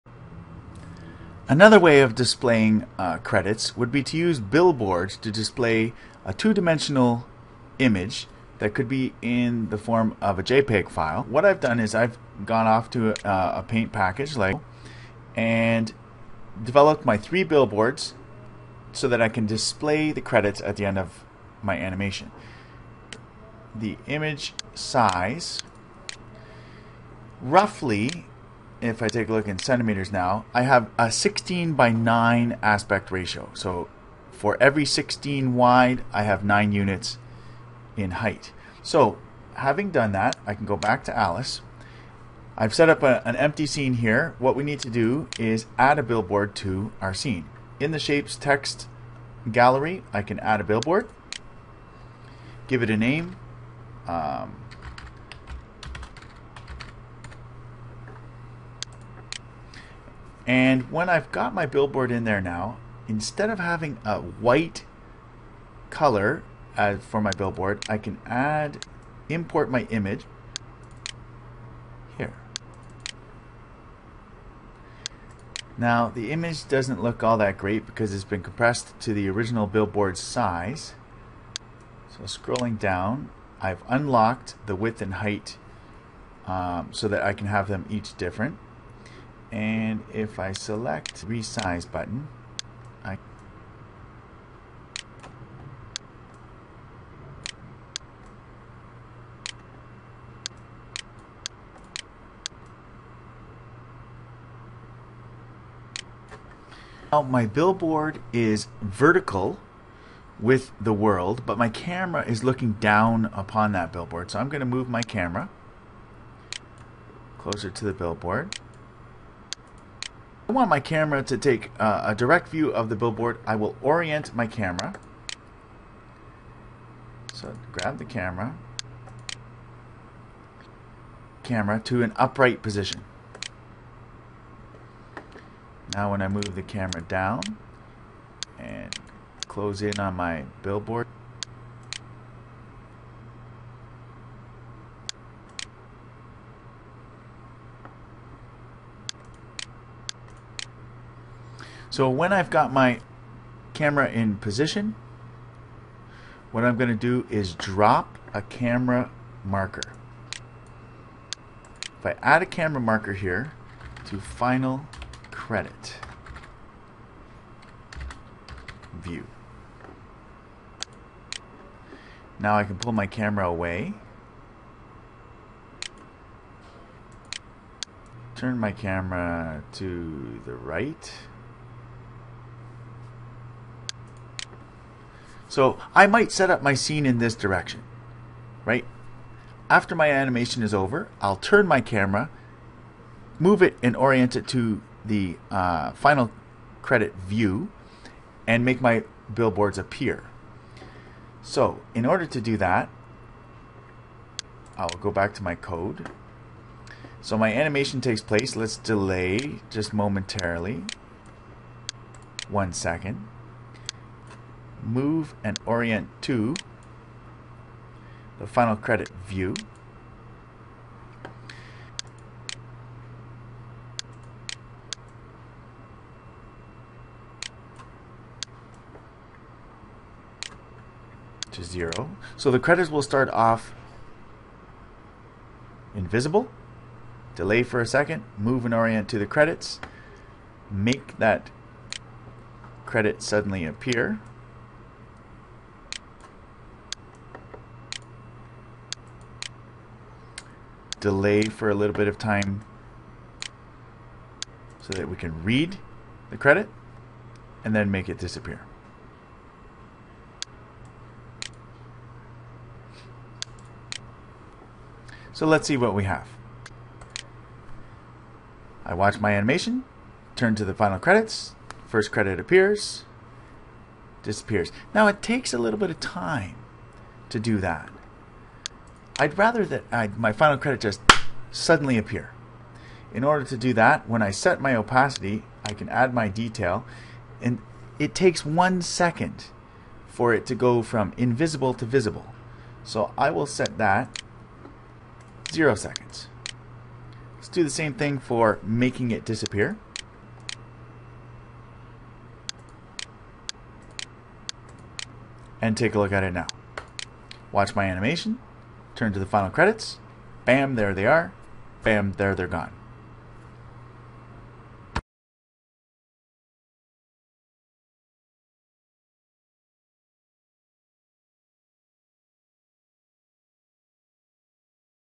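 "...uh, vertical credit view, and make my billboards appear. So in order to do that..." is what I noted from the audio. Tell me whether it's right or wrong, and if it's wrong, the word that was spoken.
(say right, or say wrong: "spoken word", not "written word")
wrong: "final", not "vertical".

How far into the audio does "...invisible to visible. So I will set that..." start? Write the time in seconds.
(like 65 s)
291 s.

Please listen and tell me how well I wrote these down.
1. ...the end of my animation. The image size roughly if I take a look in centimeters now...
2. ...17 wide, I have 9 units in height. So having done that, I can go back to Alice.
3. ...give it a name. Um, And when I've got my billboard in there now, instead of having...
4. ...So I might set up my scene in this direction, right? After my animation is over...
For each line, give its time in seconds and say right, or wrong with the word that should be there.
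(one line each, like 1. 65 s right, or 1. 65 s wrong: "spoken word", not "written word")
1. 20 s right
2. 34 s wrong: "16", not "17"
3. 52 s right
4. 185 s right.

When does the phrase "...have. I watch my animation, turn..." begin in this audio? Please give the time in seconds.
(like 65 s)
266 s.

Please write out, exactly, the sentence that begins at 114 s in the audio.
So I'm going to move my camera closer to the billboard.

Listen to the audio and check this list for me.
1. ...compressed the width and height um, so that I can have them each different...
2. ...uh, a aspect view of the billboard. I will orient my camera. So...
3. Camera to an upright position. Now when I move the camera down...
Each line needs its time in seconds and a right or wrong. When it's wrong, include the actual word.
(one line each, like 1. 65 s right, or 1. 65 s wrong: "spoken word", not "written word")
1. 83 s wrong: "unlocked", not "compressed"
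2. 121 s wrong: "direct", not "aspect"
3. 131 s right.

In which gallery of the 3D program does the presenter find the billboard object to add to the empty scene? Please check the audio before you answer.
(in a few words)
Shapes text gallery.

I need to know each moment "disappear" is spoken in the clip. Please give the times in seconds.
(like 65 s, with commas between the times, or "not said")
258 s, 274 s, 299 s.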